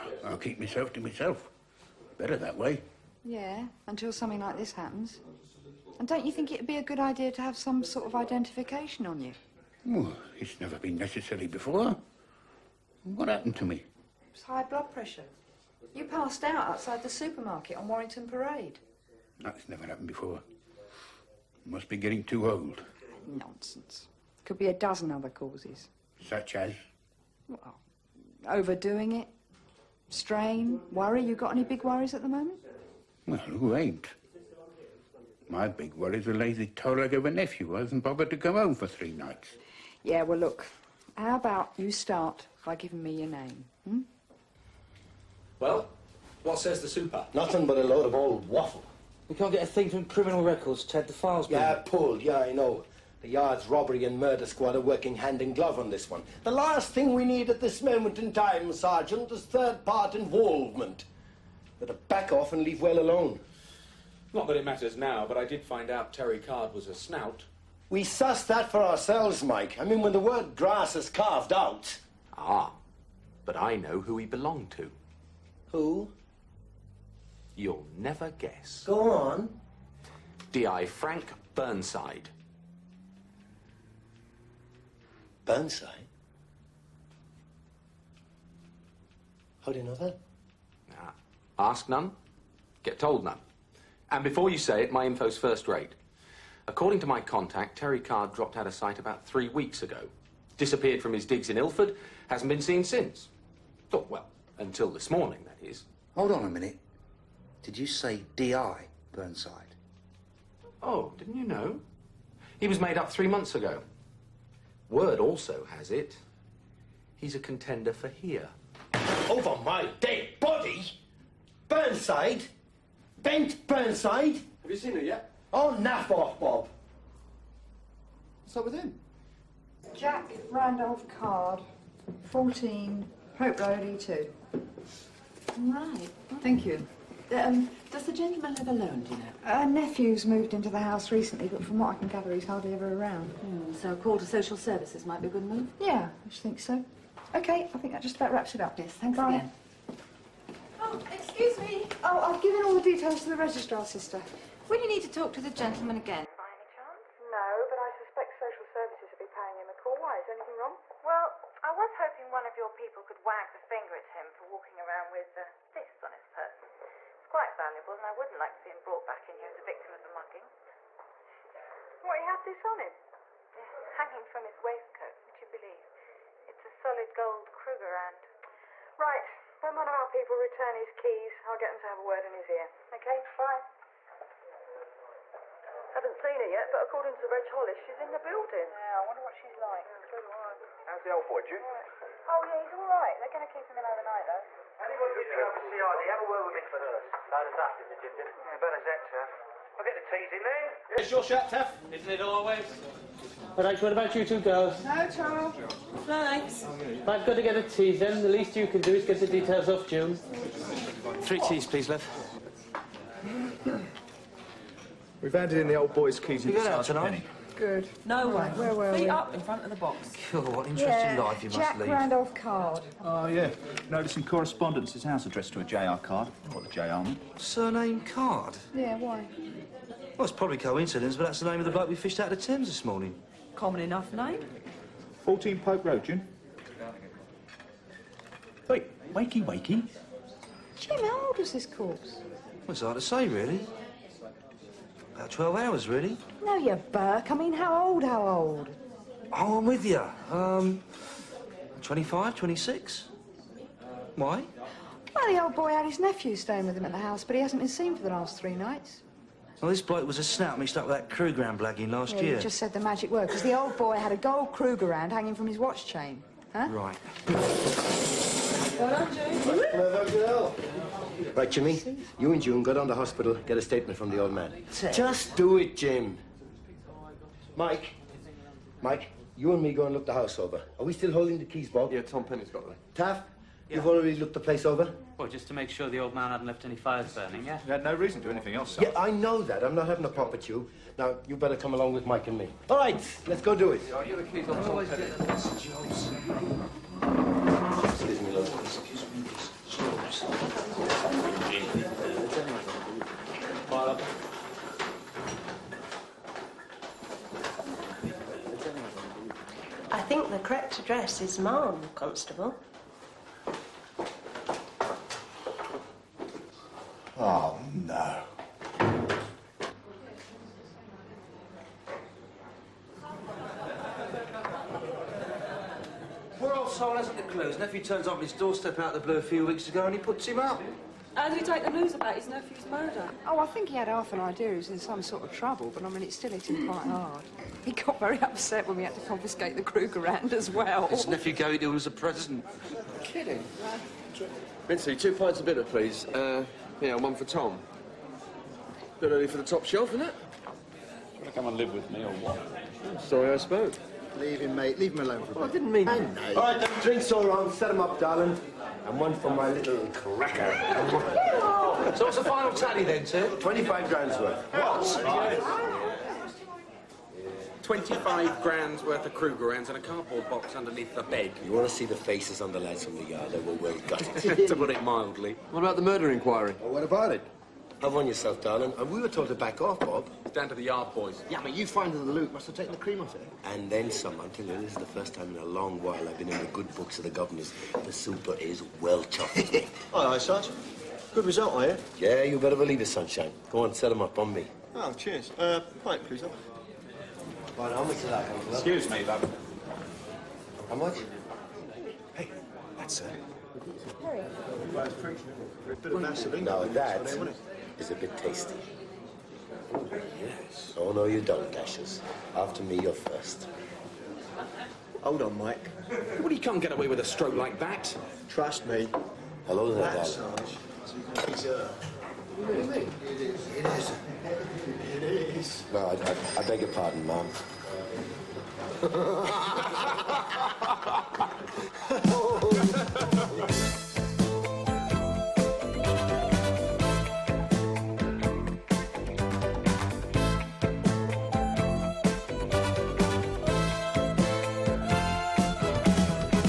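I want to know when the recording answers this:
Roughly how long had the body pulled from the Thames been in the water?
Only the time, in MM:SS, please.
04:05.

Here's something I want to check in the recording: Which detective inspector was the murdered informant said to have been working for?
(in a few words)
Frank Burnside.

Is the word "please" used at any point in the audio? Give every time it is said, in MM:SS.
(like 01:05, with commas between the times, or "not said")
03:31, 05:45, 06:35.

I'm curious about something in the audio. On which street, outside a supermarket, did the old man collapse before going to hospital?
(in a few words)
Warrington Parade.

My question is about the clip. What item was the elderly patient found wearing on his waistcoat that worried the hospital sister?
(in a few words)
solid gold Krugerrand.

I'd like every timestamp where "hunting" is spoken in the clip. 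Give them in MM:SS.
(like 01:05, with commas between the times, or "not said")
not said.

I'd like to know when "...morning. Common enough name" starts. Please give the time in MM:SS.
03:52.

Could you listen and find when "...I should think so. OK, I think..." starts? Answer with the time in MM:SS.
02:26.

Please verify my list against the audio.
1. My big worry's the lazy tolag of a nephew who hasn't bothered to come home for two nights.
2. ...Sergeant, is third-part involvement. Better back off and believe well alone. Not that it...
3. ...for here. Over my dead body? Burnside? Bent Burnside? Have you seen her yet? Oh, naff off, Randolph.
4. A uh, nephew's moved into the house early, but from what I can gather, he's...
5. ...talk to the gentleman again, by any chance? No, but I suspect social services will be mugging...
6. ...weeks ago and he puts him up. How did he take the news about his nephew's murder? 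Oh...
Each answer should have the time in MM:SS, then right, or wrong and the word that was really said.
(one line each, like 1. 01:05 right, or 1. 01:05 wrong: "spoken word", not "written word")
1. 00:35 wrong: "three", not "two"
2. 00:58 wrong: "leave", not "believe"
3. 01:57 wrong: "Bob", not "Randolph"
4. 02:19 wrong: "recently", not "early"
5. 02:35 wrong: "paying", not "mugging"
6. 05:29 right.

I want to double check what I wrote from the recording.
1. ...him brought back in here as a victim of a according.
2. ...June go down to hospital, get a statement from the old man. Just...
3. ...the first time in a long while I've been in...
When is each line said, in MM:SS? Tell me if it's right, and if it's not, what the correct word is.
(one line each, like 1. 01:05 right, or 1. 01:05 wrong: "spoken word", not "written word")
1. 02:48 wrong: "mugging", not "according"
2. 04:32 right
3. 06:24 right.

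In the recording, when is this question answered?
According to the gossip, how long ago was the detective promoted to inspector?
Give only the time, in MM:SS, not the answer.
01:53.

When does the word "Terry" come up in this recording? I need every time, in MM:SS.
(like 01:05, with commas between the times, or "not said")
01:06, 01:37.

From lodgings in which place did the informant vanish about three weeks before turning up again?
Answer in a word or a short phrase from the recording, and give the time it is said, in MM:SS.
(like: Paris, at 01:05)
Ilford, at 01:41.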